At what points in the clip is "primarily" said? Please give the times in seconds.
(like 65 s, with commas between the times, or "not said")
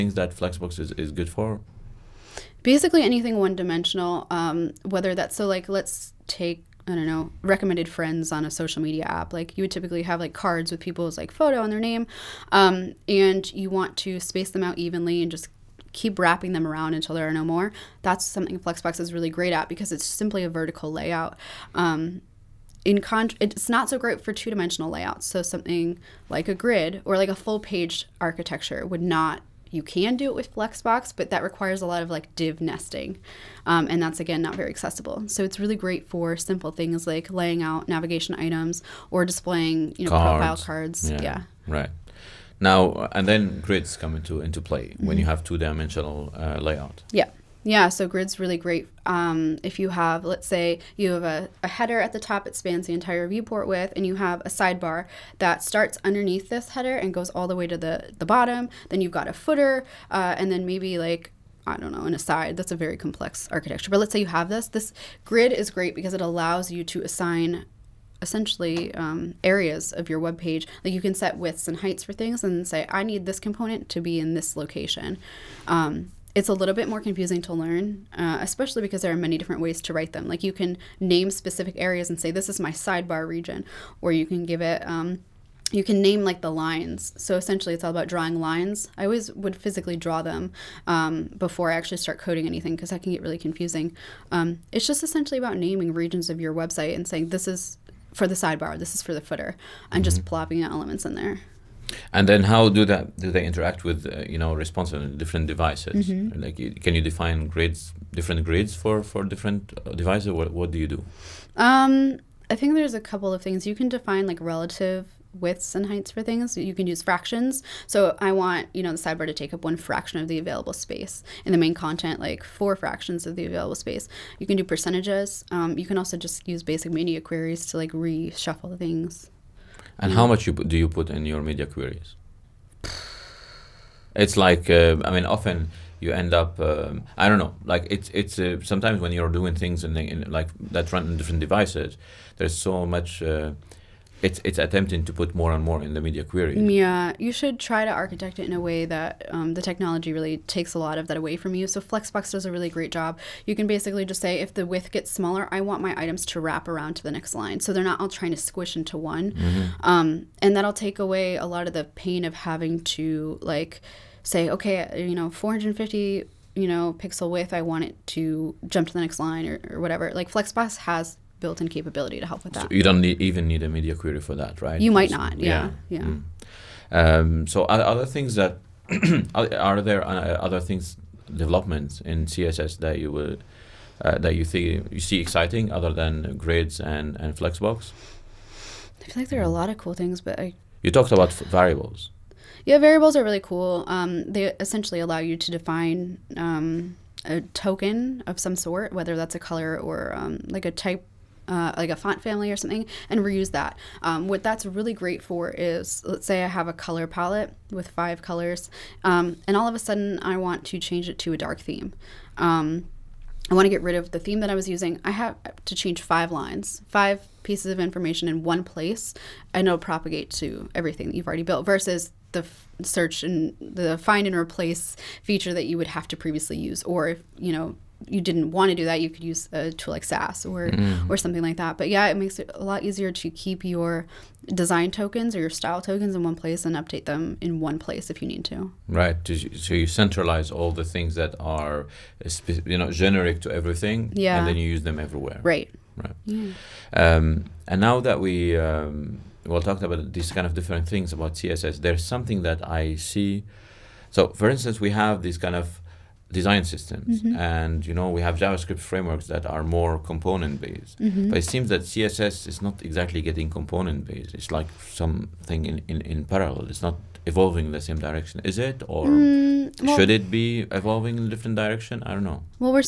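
not said.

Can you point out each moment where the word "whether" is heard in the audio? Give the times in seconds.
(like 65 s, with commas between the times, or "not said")
4 s, 198 s.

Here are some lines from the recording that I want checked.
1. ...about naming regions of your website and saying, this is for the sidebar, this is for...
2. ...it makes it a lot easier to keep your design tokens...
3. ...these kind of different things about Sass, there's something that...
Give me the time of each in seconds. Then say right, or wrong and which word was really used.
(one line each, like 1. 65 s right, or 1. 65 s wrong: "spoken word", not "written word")
1. 95 s right
2. 232 s right
3. 250 s wrong: "CSS", not "Sass".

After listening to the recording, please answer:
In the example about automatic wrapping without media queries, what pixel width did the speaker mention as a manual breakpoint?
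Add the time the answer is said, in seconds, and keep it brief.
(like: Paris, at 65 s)
450, at 165 s.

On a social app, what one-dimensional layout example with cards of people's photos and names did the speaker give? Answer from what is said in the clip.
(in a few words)
Recommended friends.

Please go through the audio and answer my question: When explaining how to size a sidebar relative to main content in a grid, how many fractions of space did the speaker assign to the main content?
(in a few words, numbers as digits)
4.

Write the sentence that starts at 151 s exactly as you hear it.
So Flexbox does a really great job.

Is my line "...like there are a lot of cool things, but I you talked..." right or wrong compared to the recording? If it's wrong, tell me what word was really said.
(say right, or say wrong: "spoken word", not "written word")
right.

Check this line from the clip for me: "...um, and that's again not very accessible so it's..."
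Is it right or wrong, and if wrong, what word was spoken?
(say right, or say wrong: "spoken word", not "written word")
right.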